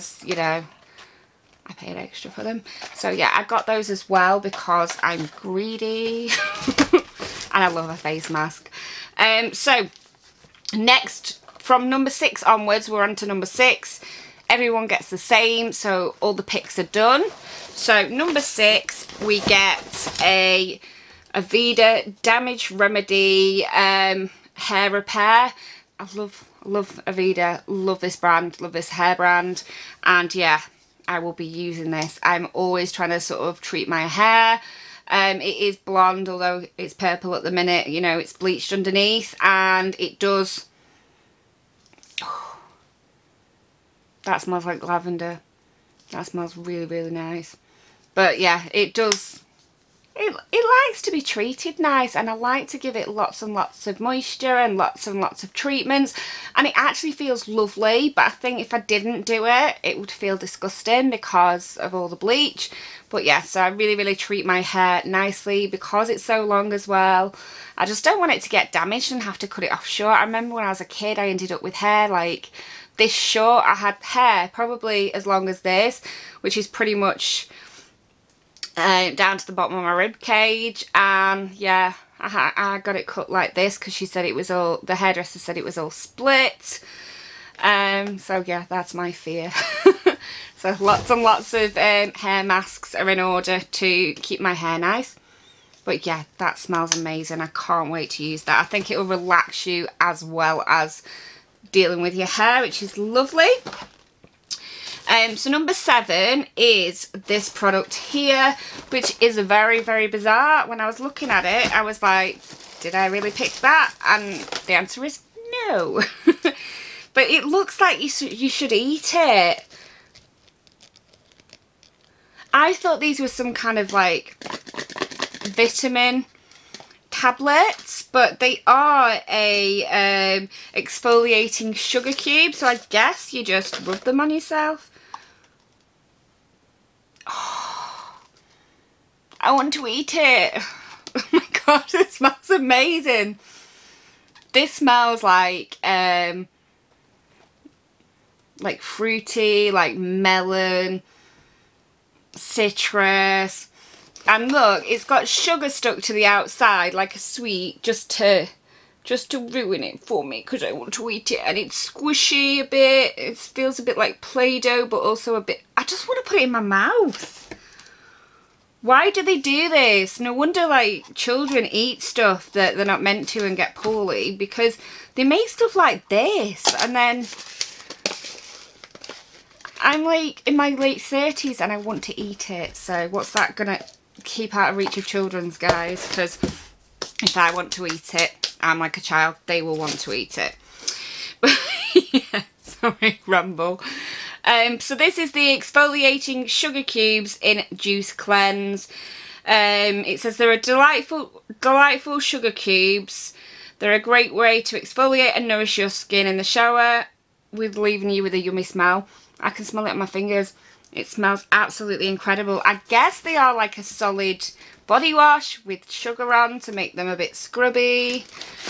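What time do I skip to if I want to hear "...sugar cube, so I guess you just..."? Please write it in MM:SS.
02:11.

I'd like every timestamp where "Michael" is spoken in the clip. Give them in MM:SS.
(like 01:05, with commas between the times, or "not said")
not said.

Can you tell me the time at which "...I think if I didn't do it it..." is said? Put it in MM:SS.
00:58.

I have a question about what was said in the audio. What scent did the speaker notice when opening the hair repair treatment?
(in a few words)
Lavender.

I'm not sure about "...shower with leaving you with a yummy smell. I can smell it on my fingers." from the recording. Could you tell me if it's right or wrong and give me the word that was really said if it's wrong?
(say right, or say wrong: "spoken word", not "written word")
right.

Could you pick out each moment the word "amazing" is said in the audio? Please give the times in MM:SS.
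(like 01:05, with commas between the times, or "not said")
01:36, 02:22.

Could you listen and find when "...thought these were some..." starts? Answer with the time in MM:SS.
02:02.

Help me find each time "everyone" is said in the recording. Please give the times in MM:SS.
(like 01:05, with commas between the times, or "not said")
00:14.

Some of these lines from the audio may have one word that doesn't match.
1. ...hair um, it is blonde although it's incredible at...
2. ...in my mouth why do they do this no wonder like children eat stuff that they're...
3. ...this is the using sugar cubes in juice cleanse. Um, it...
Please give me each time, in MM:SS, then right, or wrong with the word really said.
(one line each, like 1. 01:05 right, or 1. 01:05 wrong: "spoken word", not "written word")
1. 00:34 wrong: "purple", not "incredible"
2. 02:46 right
3. 03:14 wrong: "exfoliating", not "using".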